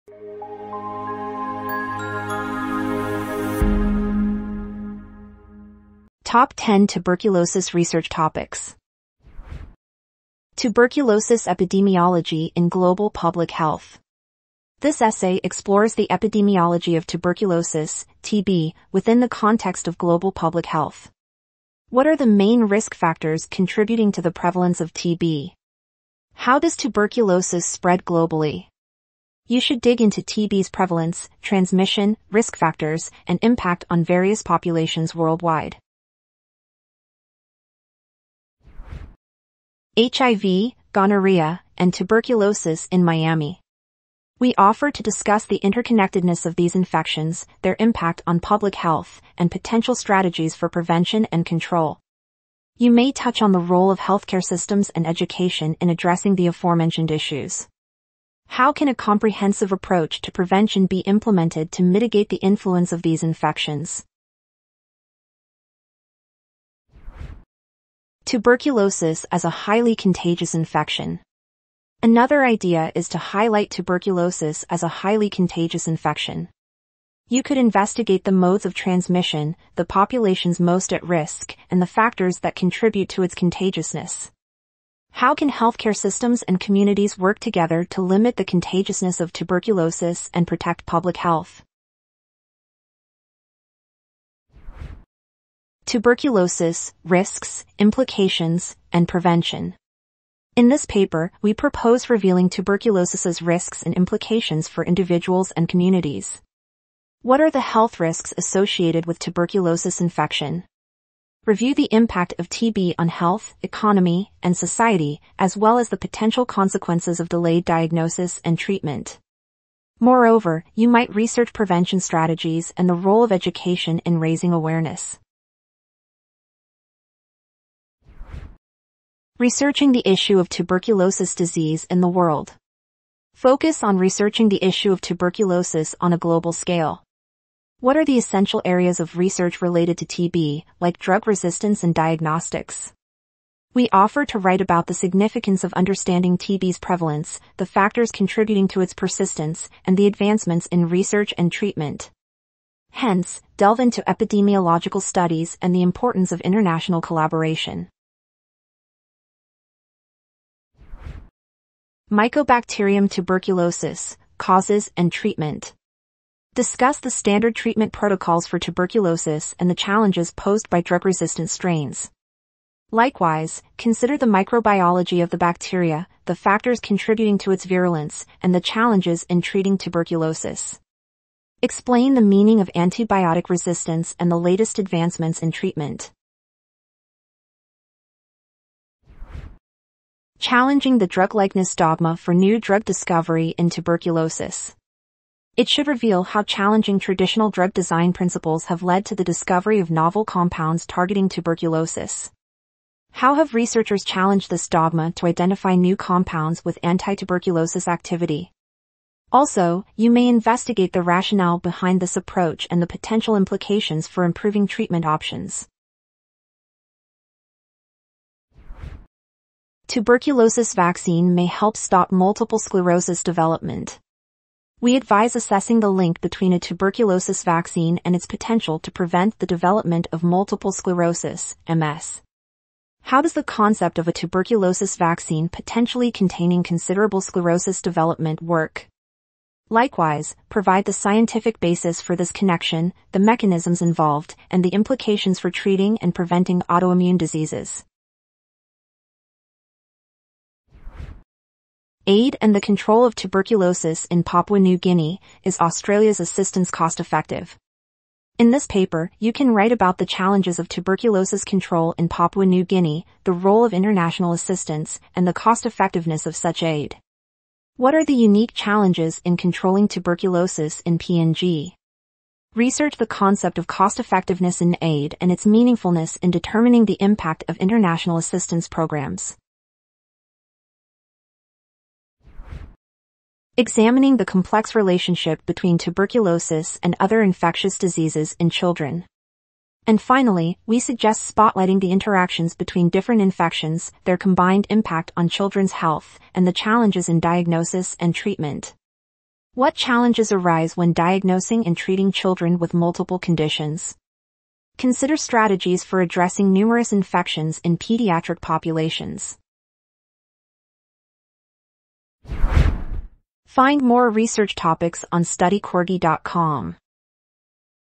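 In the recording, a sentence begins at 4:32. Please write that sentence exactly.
Research the concept of cost effectiveness in aid and its meaningfulness in determining the impact of international assistance programs.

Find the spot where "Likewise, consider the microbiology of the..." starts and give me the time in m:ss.
2:52.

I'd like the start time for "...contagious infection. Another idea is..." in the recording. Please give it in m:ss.
1:09.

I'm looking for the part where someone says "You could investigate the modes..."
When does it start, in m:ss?
1:17.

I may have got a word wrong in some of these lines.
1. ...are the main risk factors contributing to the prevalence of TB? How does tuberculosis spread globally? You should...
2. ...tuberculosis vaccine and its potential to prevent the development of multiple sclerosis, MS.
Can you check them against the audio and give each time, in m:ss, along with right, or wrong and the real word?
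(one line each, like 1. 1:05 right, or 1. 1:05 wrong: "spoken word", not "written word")
1. 0:22 right
2. 3:46 right.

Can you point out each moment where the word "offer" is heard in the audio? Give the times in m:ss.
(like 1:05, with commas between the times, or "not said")
0:44, 2:23.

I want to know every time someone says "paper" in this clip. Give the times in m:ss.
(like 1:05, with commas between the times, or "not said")
1:40, 4:18.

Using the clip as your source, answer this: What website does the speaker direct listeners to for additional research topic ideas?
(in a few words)
studycorgi.com.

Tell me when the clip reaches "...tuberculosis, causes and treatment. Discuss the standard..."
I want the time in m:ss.
2:43.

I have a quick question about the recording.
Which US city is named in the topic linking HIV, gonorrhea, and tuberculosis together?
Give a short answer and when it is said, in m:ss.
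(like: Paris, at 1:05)
Miami, at 0:43.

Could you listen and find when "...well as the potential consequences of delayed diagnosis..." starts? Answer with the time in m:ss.
1:55.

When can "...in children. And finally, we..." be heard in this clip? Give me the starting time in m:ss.
4:48.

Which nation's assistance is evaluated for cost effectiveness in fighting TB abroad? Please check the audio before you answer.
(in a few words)
Australia.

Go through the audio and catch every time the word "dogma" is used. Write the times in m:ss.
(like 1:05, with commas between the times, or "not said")
3:11, 3:24.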